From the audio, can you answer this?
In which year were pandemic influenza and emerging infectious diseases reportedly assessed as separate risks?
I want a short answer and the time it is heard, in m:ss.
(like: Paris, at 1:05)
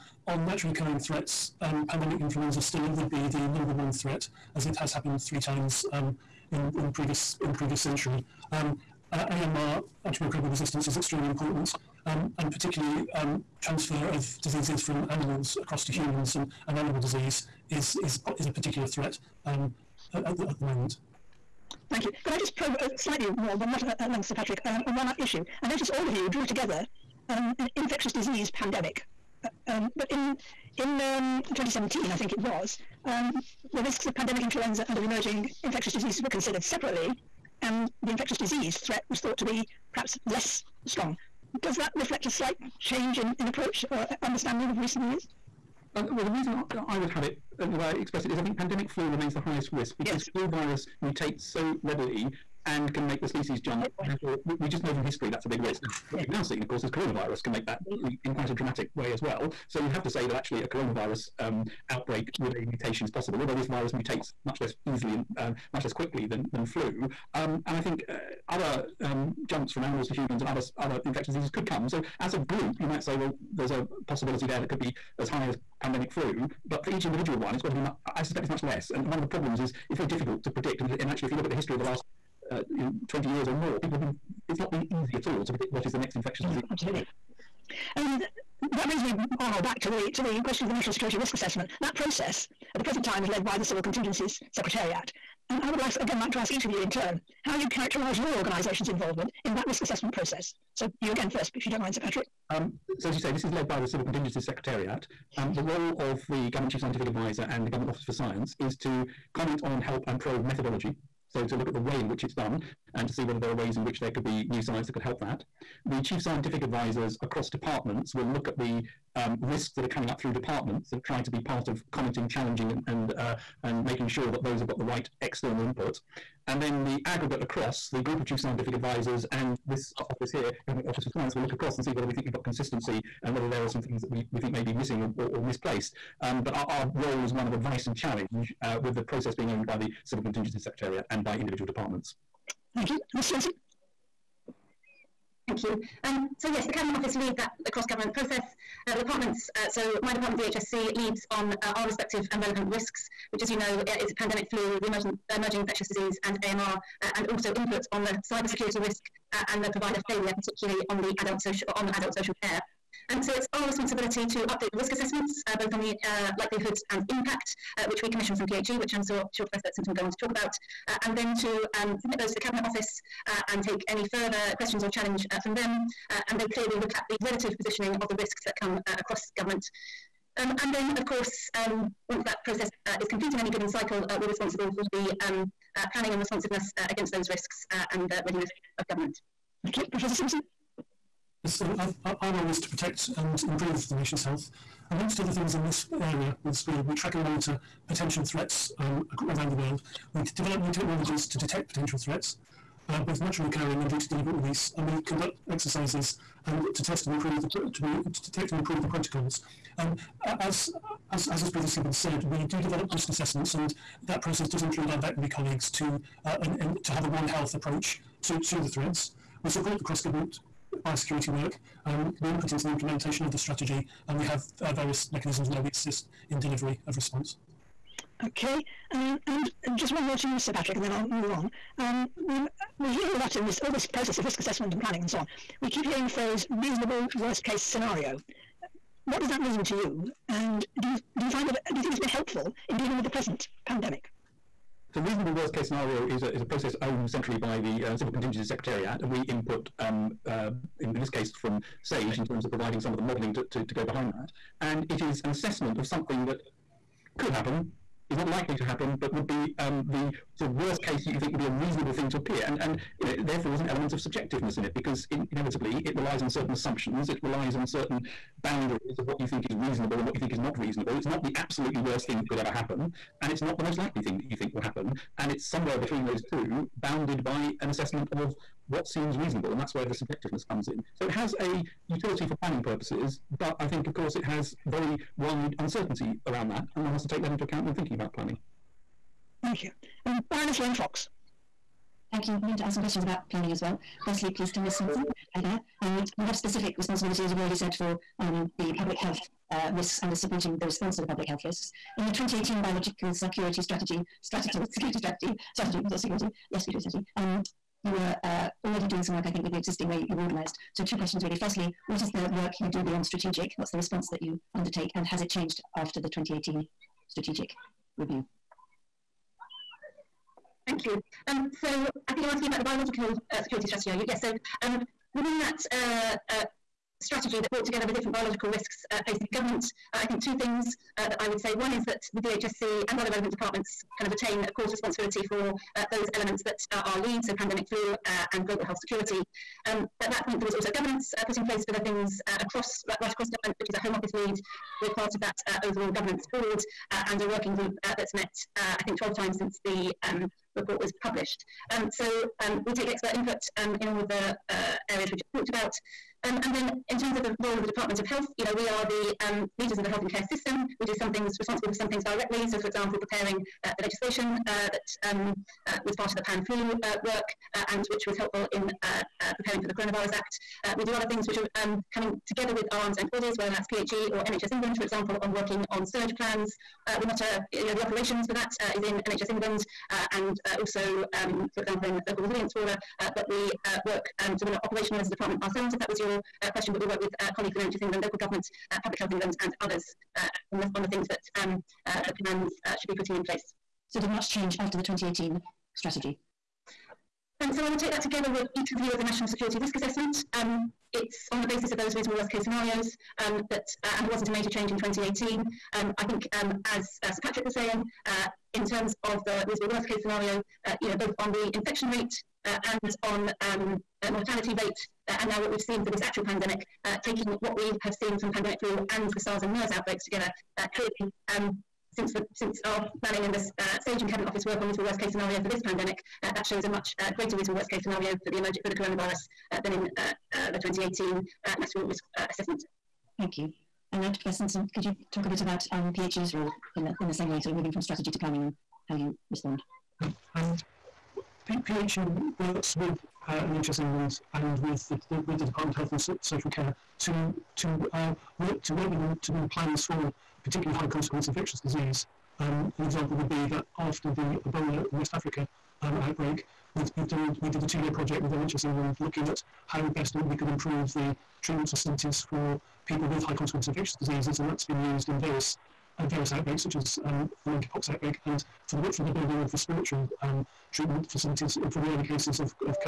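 2017, at 0:31.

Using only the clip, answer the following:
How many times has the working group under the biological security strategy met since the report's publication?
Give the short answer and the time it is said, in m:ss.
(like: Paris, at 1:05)
12, at 5:48.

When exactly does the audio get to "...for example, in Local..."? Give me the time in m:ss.
6:21.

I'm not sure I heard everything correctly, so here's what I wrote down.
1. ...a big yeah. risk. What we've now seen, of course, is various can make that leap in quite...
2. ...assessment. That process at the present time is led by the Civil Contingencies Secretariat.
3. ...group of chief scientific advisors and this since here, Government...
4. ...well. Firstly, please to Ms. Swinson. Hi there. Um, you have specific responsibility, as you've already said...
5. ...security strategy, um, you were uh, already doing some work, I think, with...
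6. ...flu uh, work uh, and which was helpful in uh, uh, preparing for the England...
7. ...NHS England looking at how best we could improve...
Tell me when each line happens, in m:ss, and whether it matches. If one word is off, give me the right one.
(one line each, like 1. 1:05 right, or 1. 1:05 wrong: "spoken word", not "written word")
1. 0:55 wrong: "coronavirus", not "various"
2. 1:31 right
3. 2:07 wrong: "office", not "since"
4. 4:53 right
5. 5:06 right
6. 6:06 wrong: "Coronavirus", not "England"
7. 7:38 right.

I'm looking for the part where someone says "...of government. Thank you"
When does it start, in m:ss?
3:08.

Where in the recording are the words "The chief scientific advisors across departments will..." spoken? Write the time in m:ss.
1:55.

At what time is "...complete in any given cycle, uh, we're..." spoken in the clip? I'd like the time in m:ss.
3:03.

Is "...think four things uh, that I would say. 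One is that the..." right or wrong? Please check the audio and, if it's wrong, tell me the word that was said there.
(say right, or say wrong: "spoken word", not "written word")
wrong: "two", not "four".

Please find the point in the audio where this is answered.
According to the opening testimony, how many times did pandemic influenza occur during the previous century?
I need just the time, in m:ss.
0:05.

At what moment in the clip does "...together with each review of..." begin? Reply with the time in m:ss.
6:38.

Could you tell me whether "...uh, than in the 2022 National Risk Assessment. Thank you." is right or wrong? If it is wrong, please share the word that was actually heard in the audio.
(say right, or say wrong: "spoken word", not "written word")
wrong: "2018", not "2022".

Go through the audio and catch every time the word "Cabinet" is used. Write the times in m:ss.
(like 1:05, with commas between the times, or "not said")
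2:26, 2:52, 7:04.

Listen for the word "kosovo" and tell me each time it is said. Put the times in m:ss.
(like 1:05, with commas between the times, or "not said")
not said.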